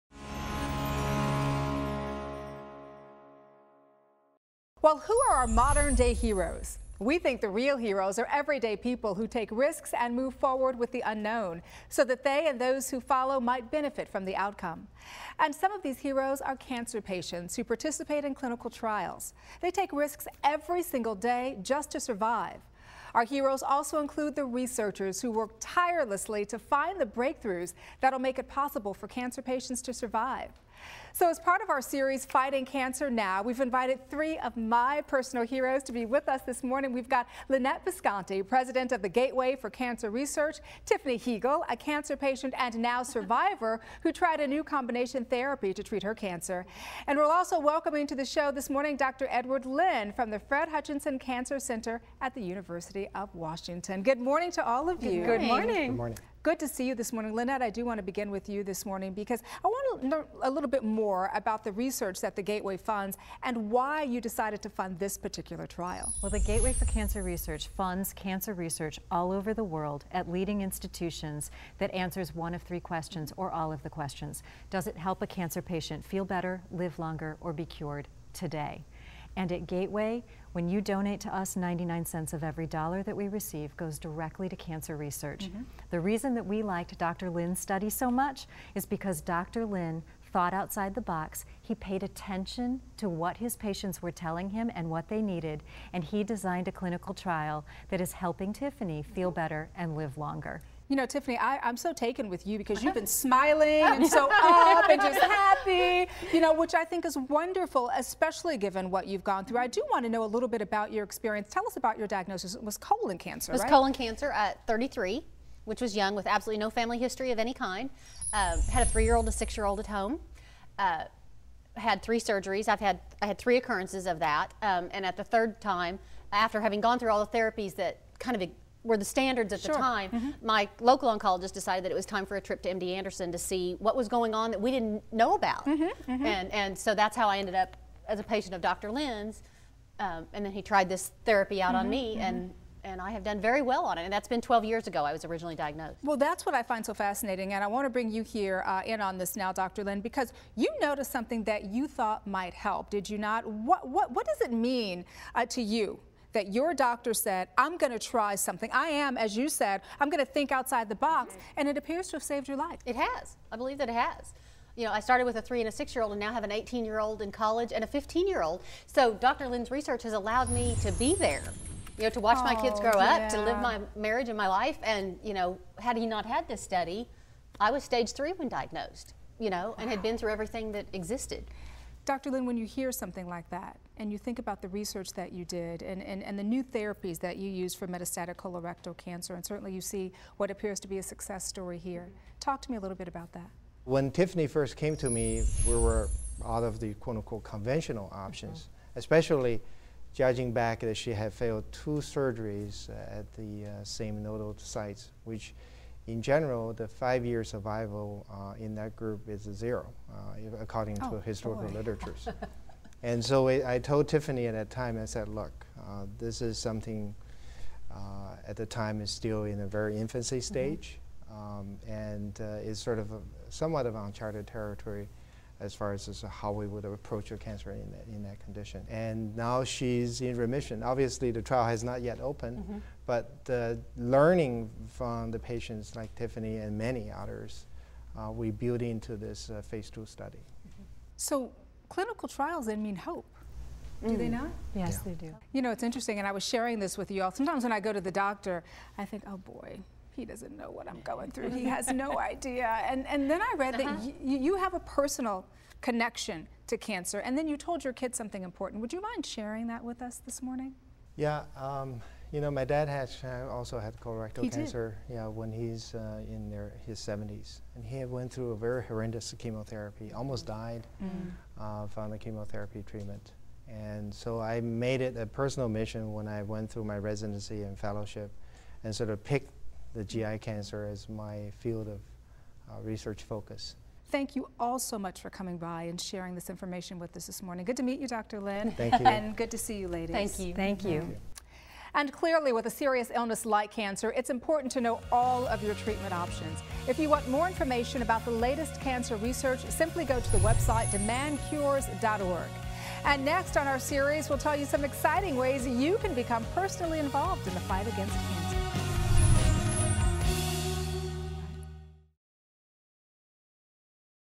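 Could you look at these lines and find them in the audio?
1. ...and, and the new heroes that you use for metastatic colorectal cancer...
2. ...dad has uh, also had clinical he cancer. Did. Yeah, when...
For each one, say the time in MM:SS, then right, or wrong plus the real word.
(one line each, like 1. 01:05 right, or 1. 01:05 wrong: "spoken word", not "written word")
1. 03:06 wrong: "therapies", not "heroes"
2. 04:22 wrong: "colorectal", not "clinical".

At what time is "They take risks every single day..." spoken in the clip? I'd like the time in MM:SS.
00:19.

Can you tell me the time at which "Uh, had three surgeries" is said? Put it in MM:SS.
02:00.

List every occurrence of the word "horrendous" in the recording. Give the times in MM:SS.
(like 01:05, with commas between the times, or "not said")
04:28.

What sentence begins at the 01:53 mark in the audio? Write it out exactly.
colon cancer at 33, which was young with absolutely no family history of any kind.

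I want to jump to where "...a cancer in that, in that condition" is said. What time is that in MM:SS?
03:47.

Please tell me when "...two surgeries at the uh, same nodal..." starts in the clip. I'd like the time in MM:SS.
03:21.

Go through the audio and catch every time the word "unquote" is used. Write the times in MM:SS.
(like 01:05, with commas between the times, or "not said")
03:17.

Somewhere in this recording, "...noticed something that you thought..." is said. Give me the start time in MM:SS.
02:30.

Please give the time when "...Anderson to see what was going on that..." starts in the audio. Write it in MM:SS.
02:12.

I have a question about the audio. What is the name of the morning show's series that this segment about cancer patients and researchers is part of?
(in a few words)
Fighting Cancer Now.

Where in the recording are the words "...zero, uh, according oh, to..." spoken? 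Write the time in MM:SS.
03:29.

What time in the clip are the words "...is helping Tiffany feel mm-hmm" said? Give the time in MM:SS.
01:38.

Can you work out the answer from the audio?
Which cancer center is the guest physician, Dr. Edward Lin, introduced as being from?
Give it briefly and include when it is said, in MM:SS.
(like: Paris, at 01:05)
Fred Hutchinson Cancer Center, at 00:50.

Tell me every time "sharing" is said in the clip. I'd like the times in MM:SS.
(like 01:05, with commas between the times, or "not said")
04:06, 04:19, 04:45.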